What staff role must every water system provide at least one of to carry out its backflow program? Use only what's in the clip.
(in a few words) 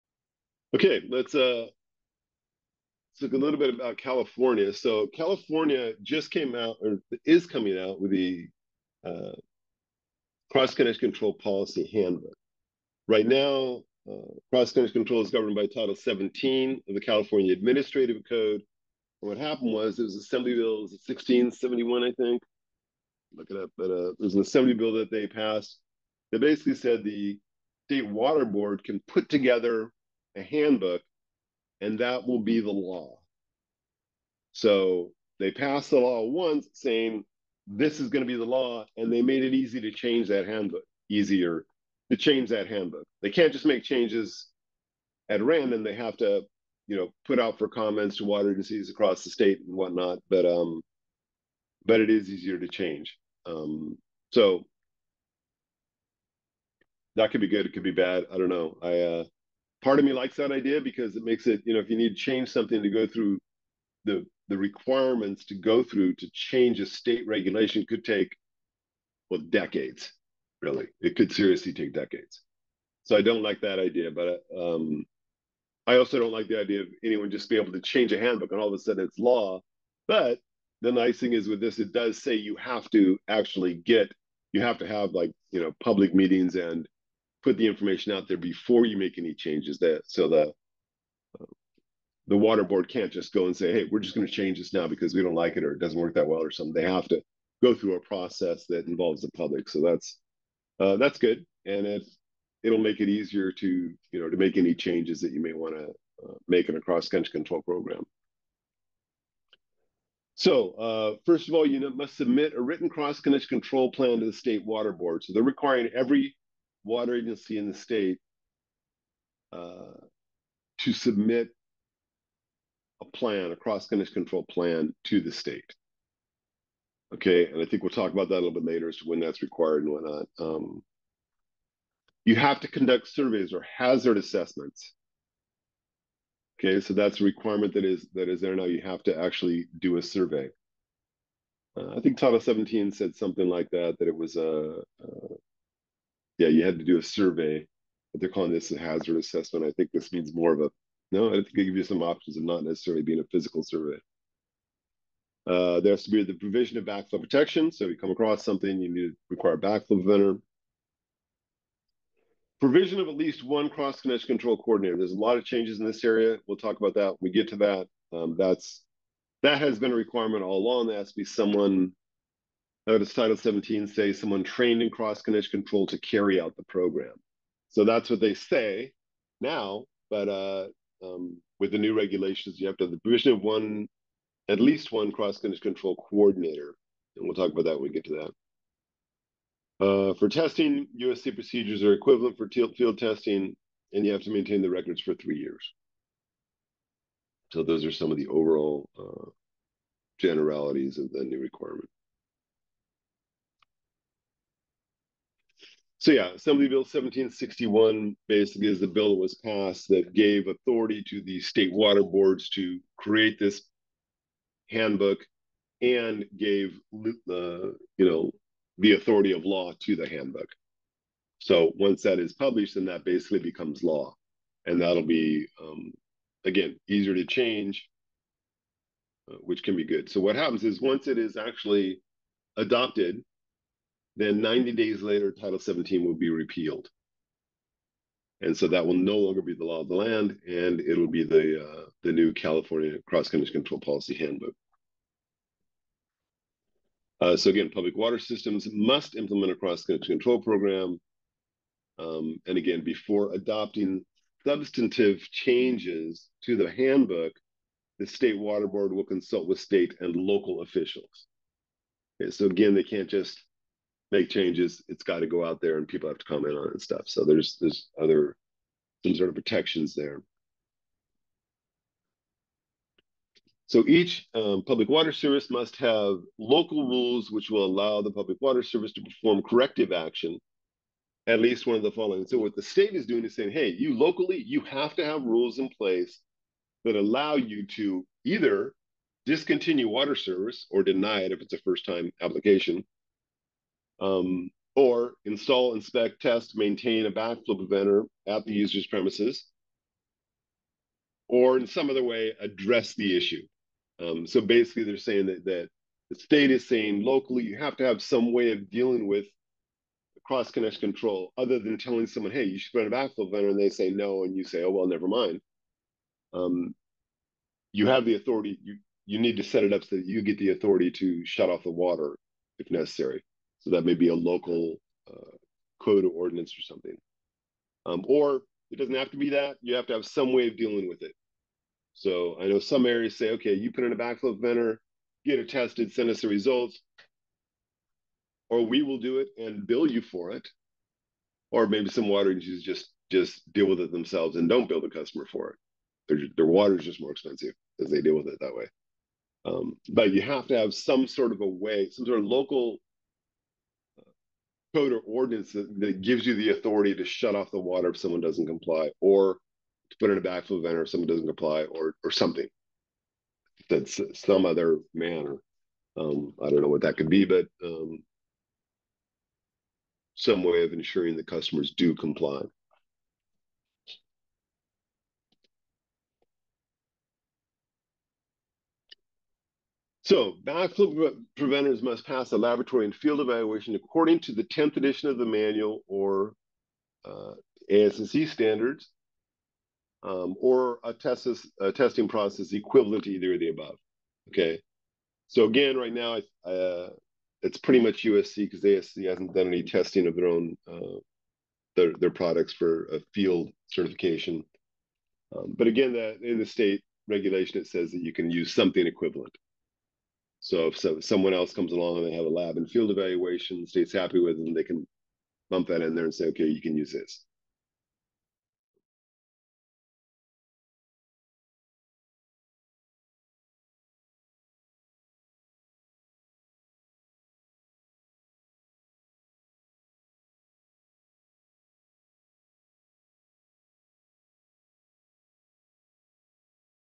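cross-connection control coordinator.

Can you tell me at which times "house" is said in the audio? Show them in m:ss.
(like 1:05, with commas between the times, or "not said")
not said.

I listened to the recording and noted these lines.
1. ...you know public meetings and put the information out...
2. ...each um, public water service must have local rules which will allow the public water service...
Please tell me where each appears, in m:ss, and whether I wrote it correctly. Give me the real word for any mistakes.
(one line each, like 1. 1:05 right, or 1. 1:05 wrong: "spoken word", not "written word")
1. 1:25 right
2. 4:33 right.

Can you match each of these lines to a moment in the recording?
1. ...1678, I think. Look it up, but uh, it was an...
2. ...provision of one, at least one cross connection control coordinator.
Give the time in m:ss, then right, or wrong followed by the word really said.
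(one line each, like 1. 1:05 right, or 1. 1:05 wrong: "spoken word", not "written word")
1. 0:20 wrong: "1671", not "1678"
2. 3:02 right.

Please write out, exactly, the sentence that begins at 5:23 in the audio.
So that may be a local uh, code or ordinance or something.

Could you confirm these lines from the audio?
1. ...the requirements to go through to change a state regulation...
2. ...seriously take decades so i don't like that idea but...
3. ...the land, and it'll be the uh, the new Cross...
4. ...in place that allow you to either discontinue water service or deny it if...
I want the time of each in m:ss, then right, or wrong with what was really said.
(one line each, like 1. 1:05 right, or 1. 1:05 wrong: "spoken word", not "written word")
1. 1:04 right
2. 1:11 right
3. 3:59 wrong: "California", not "Cross"
4. 4:45 right.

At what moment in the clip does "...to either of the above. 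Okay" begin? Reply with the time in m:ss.
6:33.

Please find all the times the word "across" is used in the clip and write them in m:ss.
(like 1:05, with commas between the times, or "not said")
0:48, 2:38.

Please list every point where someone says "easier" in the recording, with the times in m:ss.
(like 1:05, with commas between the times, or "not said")
0:41, 0:52, 1:43, 3:46.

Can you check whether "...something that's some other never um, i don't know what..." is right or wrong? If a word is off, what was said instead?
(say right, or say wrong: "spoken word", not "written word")
wrong: "manner", not "never".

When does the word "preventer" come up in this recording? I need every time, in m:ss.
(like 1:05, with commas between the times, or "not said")
2:40, 4:57, 5:13, 5:34, 6:21.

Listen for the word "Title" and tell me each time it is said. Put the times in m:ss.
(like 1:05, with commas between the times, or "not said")
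0:15, 2:22, 2:53, 3:55.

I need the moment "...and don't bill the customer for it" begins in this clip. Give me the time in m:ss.
5:44.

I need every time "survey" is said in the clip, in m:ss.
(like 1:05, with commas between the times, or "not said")
2:13, 2:20, 2:27, 2:33.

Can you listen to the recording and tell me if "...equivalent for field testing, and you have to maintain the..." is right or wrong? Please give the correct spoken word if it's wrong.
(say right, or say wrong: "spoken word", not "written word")
right.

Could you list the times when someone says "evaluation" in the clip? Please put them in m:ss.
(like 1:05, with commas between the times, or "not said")
6:23, 6:52.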